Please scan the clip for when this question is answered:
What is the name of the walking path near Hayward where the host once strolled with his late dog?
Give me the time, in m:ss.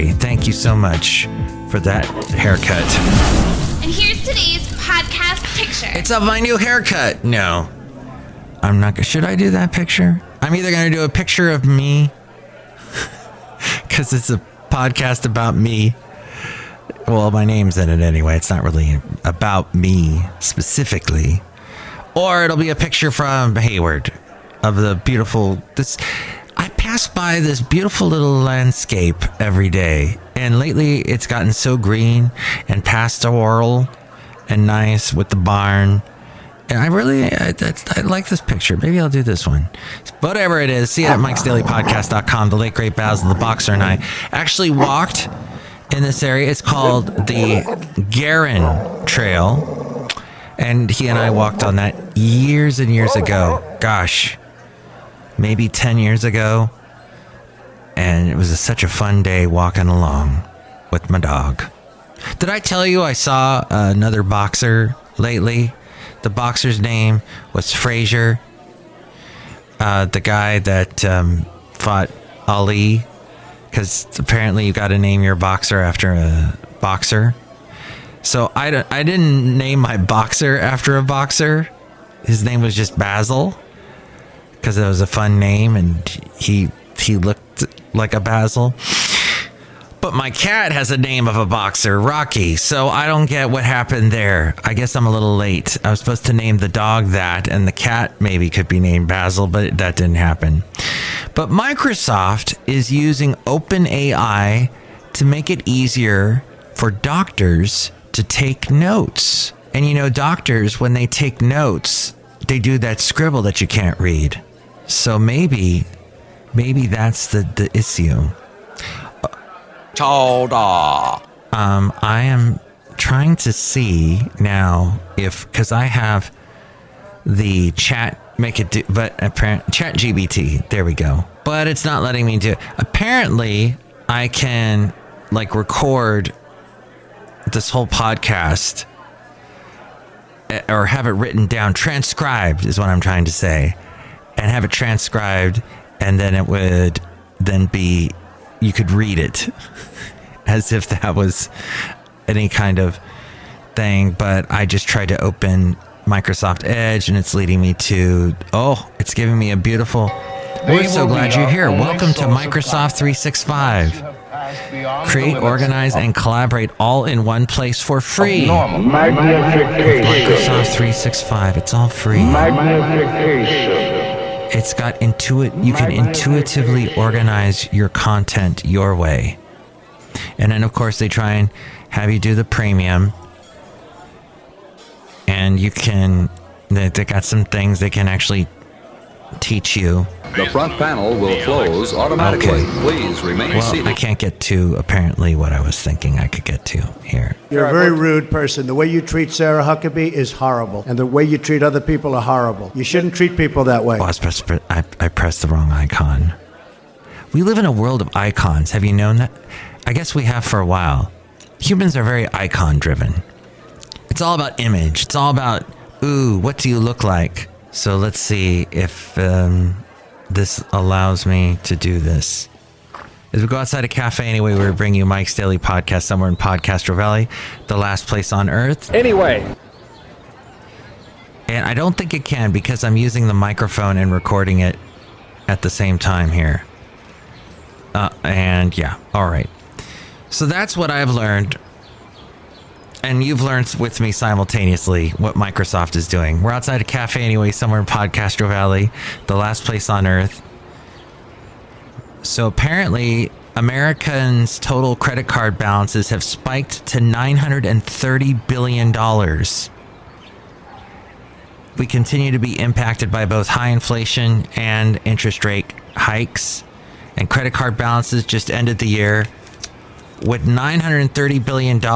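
0:48.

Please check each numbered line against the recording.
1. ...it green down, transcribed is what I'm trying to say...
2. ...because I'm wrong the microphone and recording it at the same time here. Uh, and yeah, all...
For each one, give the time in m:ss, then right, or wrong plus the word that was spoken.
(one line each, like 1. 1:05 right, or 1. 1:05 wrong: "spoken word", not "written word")
1. 2:21 wrong: "written", not "green"
2. 3:52 wrong: "using", not "wrong".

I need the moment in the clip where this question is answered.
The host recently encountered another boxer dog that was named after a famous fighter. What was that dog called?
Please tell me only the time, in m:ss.
1:07.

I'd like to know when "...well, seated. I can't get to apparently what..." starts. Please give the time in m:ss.
3:13.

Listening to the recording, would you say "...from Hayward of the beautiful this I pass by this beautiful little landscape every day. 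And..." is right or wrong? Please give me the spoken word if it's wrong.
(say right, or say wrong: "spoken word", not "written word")
right.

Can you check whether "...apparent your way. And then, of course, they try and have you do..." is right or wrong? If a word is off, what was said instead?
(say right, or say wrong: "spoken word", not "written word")
wrong: "content", not "apparent".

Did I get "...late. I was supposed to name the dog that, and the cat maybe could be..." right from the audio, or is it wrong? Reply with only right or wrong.
right.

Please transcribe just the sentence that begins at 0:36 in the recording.
And I really, I, I, like this picture.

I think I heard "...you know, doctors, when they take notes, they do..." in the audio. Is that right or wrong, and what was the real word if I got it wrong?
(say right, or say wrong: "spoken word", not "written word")
right.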